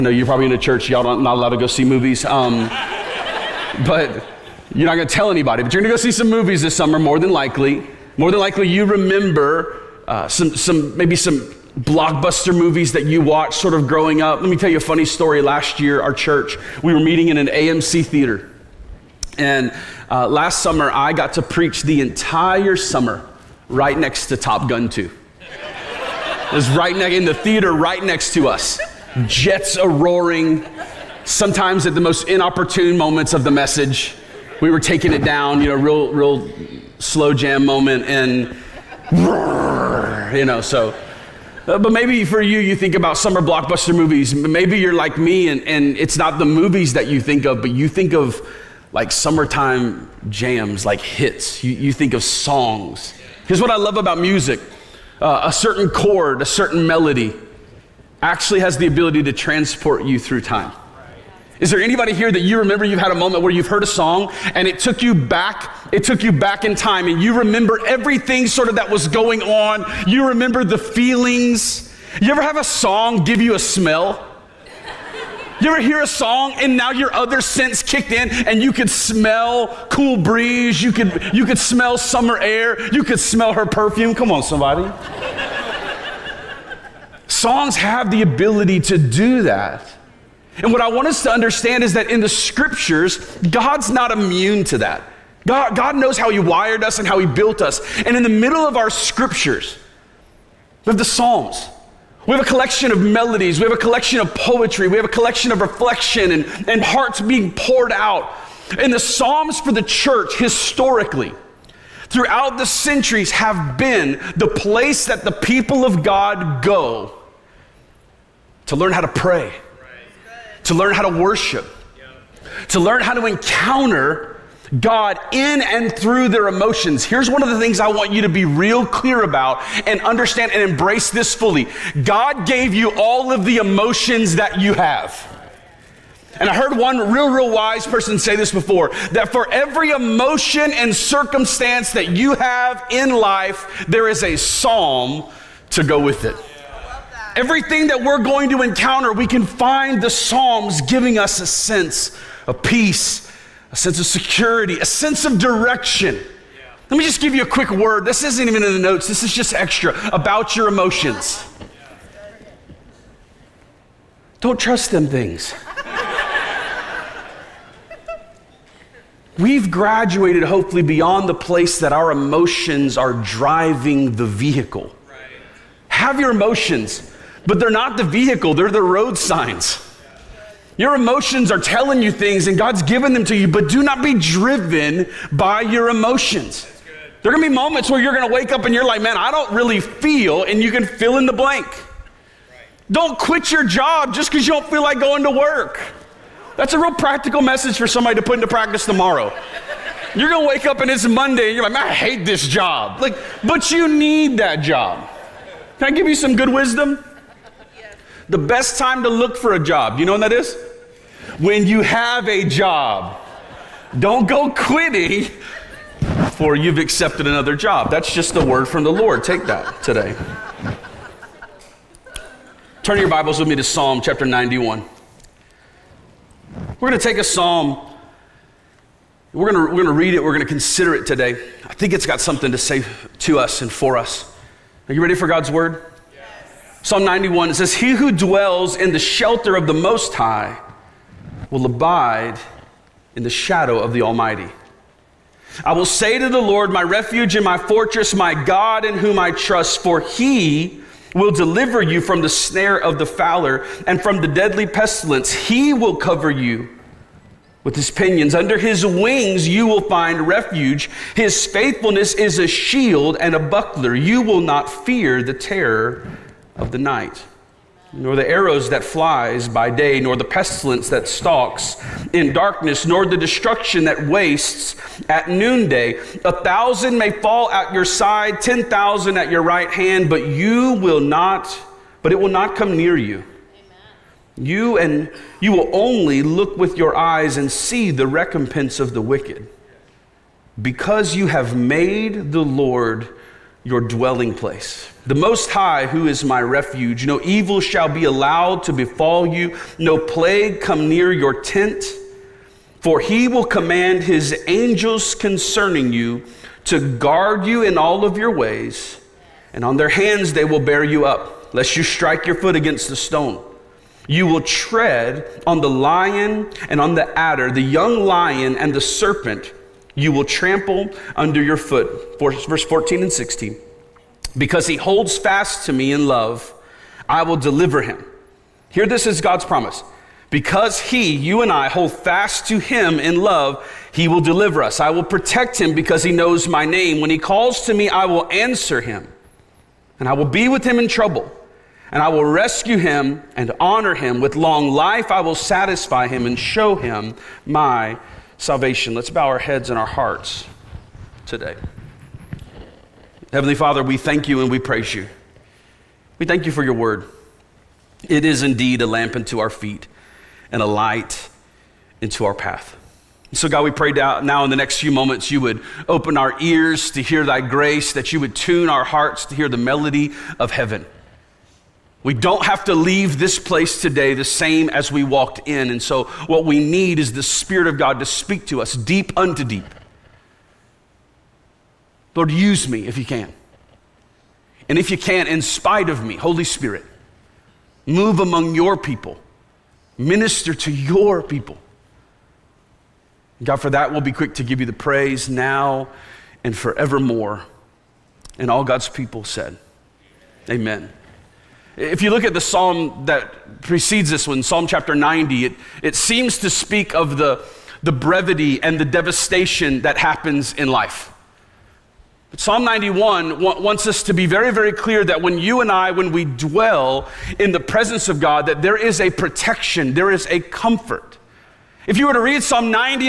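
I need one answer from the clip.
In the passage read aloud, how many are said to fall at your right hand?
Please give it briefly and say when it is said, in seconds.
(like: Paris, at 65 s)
10,000, at 278 s.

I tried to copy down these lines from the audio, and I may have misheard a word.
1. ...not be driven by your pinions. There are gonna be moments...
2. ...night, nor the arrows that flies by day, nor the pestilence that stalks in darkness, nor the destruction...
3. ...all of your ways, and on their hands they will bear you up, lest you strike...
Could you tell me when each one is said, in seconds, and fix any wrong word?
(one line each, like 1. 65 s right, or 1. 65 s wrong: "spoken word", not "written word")
1. 183 s wrong: "emotions", not "pinions"
2. 266 s right
3. 307 s right.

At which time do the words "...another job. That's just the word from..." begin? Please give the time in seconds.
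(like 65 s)
217 s.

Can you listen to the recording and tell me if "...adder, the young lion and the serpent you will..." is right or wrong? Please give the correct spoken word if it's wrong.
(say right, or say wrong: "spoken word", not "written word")
right.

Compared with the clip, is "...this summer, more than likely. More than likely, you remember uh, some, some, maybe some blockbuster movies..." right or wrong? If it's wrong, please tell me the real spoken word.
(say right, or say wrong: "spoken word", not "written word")
right.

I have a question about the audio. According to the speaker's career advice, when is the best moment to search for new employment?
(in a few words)
When you have a job.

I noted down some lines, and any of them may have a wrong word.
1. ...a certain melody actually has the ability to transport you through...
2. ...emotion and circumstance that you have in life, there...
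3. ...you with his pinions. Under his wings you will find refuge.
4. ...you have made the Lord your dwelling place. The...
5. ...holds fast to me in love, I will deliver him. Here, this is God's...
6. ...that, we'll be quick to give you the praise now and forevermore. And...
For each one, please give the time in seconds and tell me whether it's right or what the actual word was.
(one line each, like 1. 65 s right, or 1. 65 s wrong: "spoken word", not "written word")
1. 56 s right
2. 139 s right
3. 256 s right
4. 291 s right
5. 324 s right
6. 393 s right.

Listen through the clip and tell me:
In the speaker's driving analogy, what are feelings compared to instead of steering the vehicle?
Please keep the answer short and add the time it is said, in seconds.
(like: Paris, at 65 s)
road signs, at 178 s.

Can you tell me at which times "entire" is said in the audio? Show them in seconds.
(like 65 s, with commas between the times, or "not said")
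22 s.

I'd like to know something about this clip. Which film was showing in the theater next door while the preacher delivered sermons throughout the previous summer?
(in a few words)
Top Gun 2.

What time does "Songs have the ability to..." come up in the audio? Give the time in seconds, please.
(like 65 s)
87 s.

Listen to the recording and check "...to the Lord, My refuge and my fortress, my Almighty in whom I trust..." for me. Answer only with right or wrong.
wrong.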